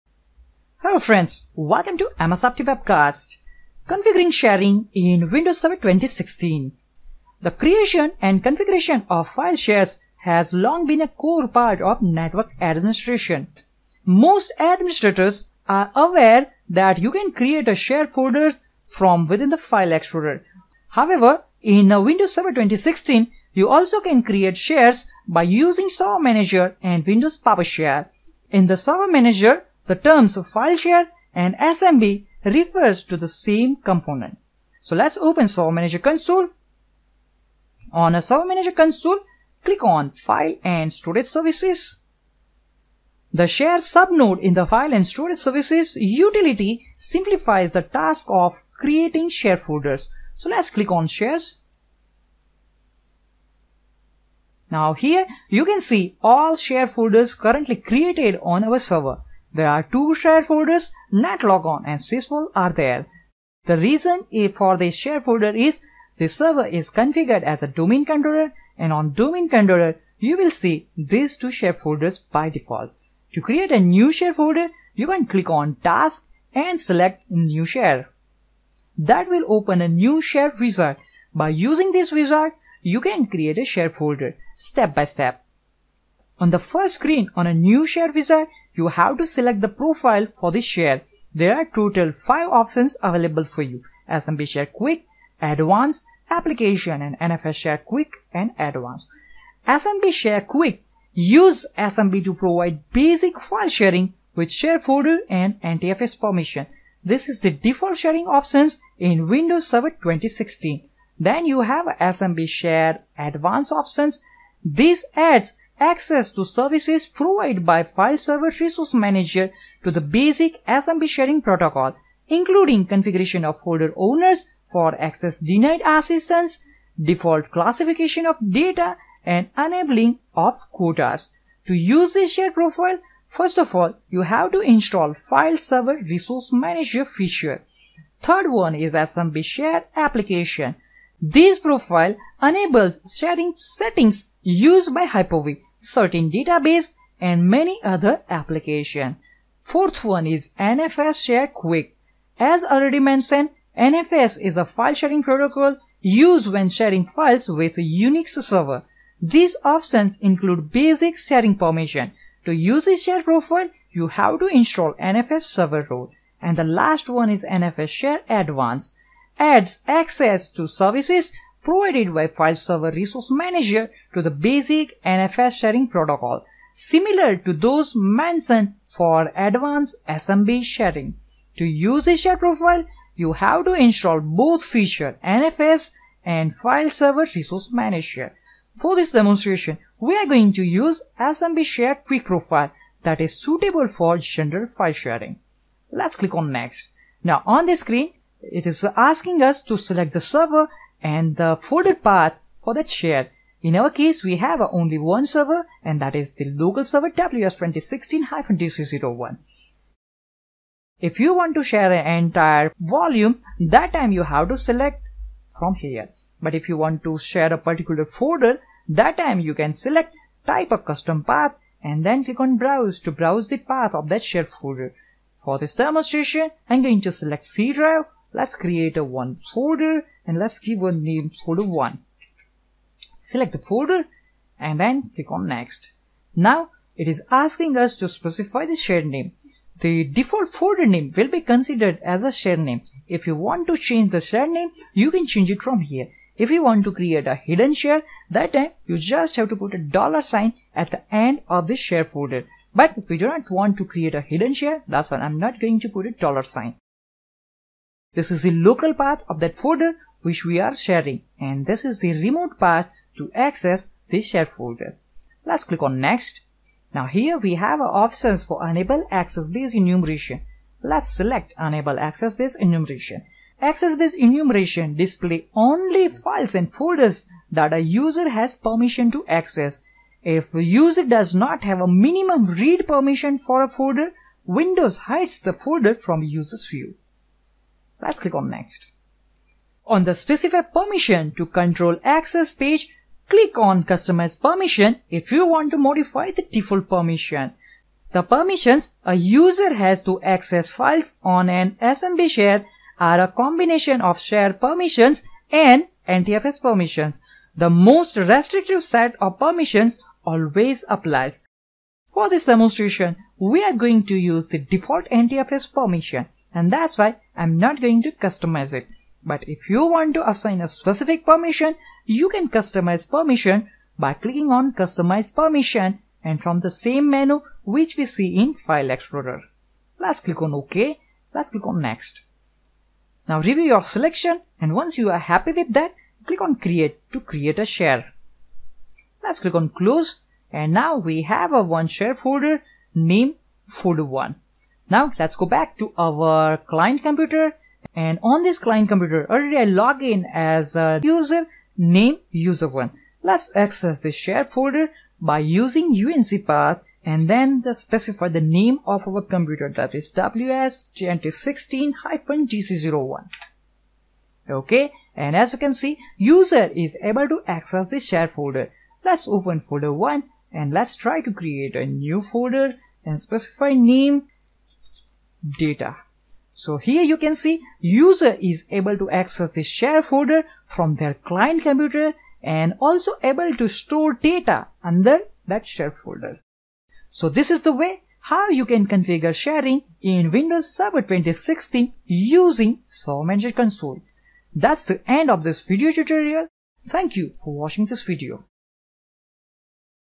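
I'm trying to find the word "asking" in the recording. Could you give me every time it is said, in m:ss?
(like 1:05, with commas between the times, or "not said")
3:18, 3:57.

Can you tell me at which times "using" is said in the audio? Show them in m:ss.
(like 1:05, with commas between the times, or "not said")
0:25, 1:21, 5:55, 6:32.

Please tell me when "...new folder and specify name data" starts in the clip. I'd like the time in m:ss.
6:11.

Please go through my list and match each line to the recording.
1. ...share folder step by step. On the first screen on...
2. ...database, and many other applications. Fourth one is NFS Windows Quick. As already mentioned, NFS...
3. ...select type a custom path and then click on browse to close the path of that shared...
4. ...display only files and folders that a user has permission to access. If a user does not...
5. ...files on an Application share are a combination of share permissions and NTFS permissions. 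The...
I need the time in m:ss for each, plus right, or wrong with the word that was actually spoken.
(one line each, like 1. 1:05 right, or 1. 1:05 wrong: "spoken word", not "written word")
1. 1:23 right
2. 2:26 wrong: "Share", not "Windows"
3. 3:39 wrong: "browse", not "close"
4. 4:34 right
5. 5:00 wrong: "SMB", not "Application".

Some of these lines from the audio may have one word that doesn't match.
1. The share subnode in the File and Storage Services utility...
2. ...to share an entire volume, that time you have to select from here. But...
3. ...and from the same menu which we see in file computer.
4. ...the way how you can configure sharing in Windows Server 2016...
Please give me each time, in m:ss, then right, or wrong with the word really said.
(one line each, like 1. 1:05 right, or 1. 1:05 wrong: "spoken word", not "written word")
1. 0:43 right
2. 3:31 right
3. 5:26 wrong: "explorer", not "computer"
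4. 6:27 right.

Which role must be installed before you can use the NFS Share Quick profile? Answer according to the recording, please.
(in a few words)
NFS server role.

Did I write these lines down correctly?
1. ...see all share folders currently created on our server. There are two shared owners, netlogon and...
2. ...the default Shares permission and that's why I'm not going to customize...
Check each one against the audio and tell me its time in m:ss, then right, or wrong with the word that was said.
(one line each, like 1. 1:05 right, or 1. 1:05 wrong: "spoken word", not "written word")
1. 0:55 wrong: "folders", not "owners"
2. 5:14 wrong: "NTFS", not "Shares".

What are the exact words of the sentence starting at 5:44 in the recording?
Now let's go back to our client computer and on this client computer, already I log in as a user name user1.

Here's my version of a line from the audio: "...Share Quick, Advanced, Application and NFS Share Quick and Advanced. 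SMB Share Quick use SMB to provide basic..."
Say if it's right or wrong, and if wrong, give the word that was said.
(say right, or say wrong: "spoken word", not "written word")
right.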